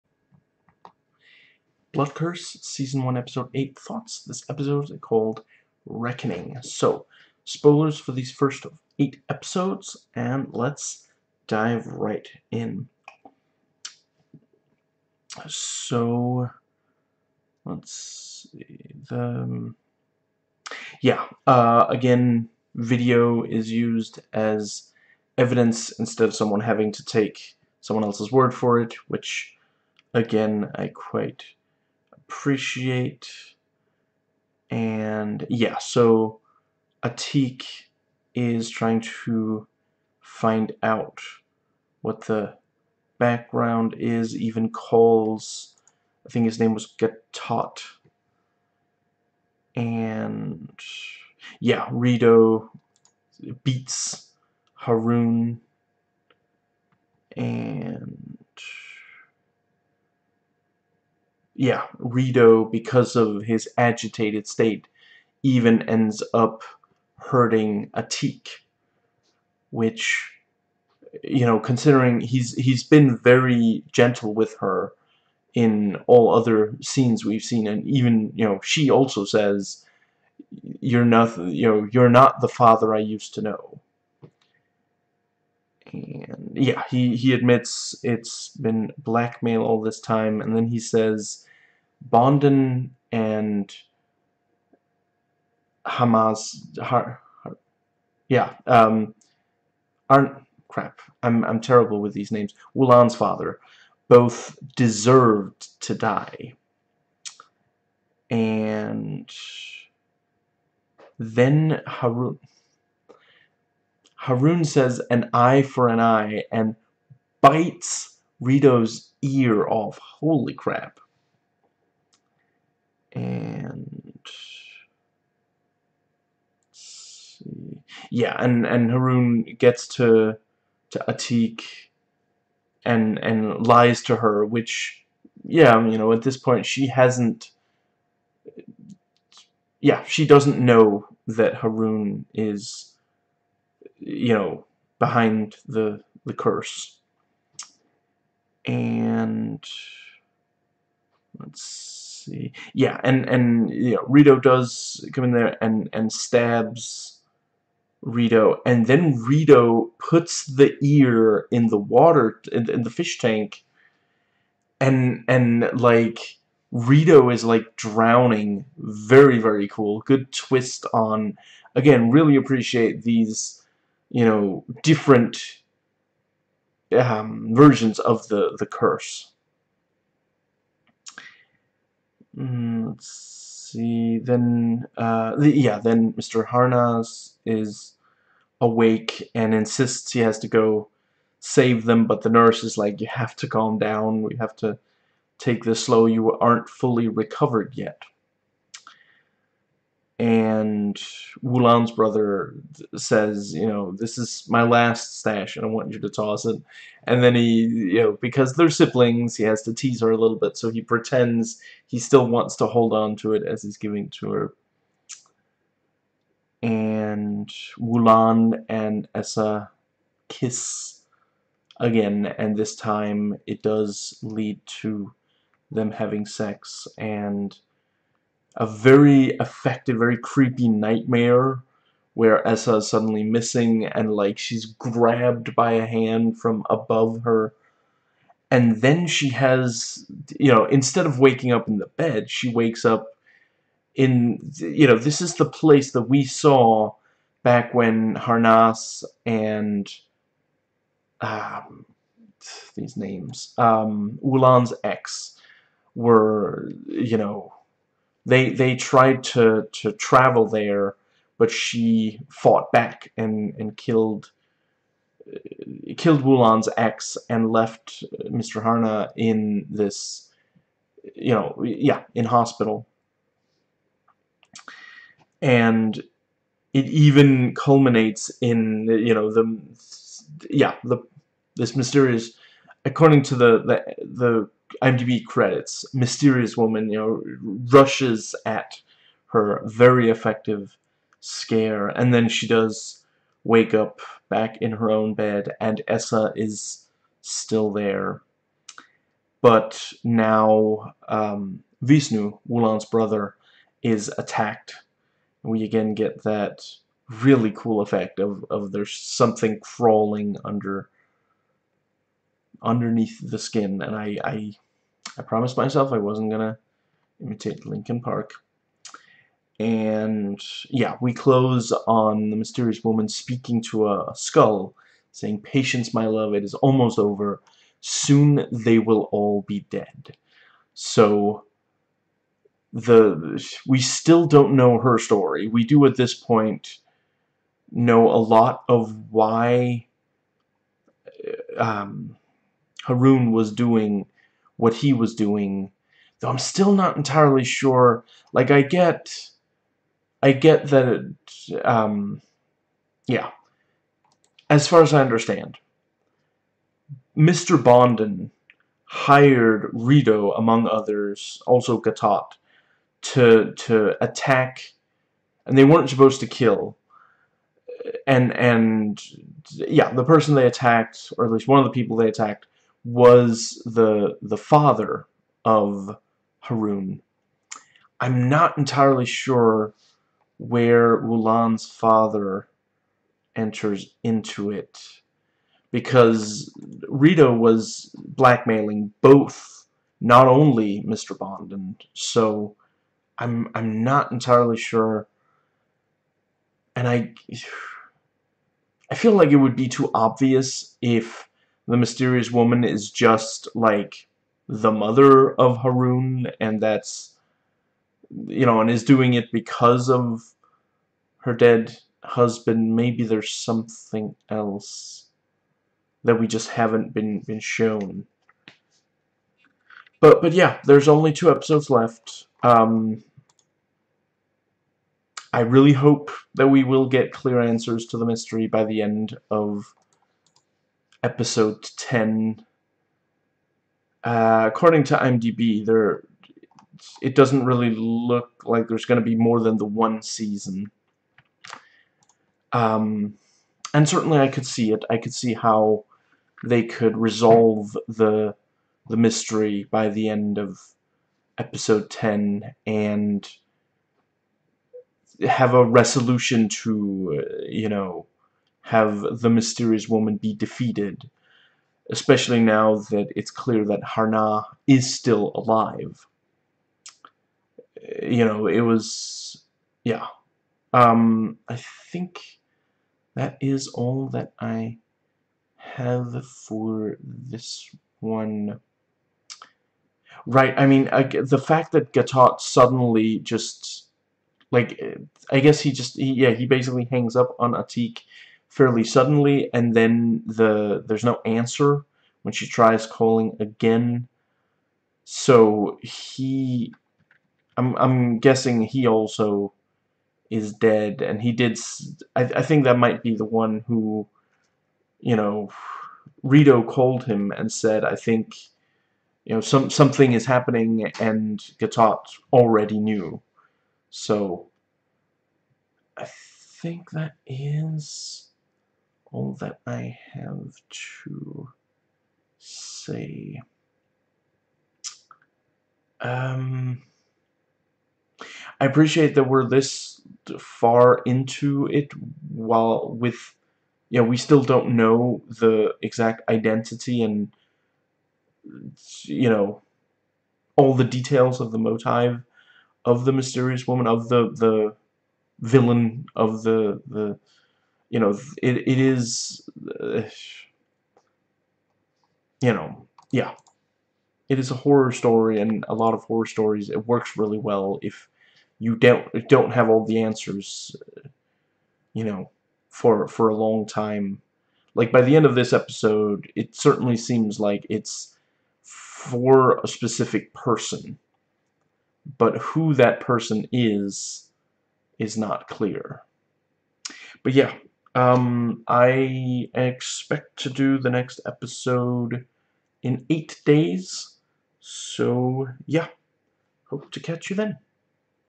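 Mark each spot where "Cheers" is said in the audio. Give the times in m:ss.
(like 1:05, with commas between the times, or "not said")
not said.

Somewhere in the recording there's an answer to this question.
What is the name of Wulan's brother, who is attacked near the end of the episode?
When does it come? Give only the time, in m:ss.
5:01.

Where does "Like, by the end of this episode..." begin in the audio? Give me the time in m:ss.
9:24.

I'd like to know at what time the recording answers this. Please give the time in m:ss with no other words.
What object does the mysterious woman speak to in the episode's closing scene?
5:24.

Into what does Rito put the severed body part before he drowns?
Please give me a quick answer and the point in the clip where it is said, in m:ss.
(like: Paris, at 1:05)
Fish tank, at 2:42.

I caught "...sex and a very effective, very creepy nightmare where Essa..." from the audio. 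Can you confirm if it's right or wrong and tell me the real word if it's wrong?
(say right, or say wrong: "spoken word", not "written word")
right.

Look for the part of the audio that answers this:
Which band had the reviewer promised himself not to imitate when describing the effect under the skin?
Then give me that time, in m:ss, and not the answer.
5:17.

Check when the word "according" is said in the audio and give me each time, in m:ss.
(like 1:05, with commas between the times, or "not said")
4:42, 7:14.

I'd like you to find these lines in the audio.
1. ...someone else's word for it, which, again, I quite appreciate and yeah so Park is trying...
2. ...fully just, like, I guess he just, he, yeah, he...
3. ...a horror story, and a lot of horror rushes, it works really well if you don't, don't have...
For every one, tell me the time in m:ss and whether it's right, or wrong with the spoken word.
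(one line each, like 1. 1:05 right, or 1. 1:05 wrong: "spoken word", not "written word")
1. 0:27 wrong: "Atik", not "Park"
2. 8:02 wrong: "suddenly", not "fully"
3. 9:14 wrong: "stories", not "rushes".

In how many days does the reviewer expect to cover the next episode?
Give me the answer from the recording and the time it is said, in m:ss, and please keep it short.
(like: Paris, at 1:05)
8, at 9:43.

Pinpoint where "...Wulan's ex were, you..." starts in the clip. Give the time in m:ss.
4:14.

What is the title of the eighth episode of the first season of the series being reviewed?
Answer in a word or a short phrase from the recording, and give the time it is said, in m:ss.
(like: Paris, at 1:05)
Reckoning, at 0:05.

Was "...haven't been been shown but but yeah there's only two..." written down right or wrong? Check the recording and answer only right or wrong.
right.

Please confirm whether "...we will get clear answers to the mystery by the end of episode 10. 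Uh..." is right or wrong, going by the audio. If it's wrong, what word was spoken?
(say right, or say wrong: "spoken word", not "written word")
right.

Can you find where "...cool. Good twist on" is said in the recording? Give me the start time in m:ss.
2:49.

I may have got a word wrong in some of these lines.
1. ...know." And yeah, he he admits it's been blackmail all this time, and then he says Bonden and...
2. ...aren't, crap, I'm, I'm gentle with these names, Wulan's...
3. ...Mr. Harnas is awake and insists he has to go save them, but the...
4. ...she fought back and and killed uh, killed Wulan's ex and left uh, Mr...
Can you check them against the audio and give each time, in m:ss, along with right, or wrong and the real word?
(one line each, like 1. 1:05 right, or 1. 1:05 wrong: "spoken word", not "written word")
1. 1:23 right
2. 1:40 wrong: "terrible", not "gentle"
3. 3:06 right
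4. 4:21 right.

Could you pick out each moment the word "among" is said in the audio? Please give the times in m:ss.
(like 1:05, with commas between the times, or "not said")
6:00.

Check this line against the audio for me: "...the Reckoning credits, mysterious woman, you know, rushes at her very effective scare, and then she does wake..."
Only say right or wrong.
wrong.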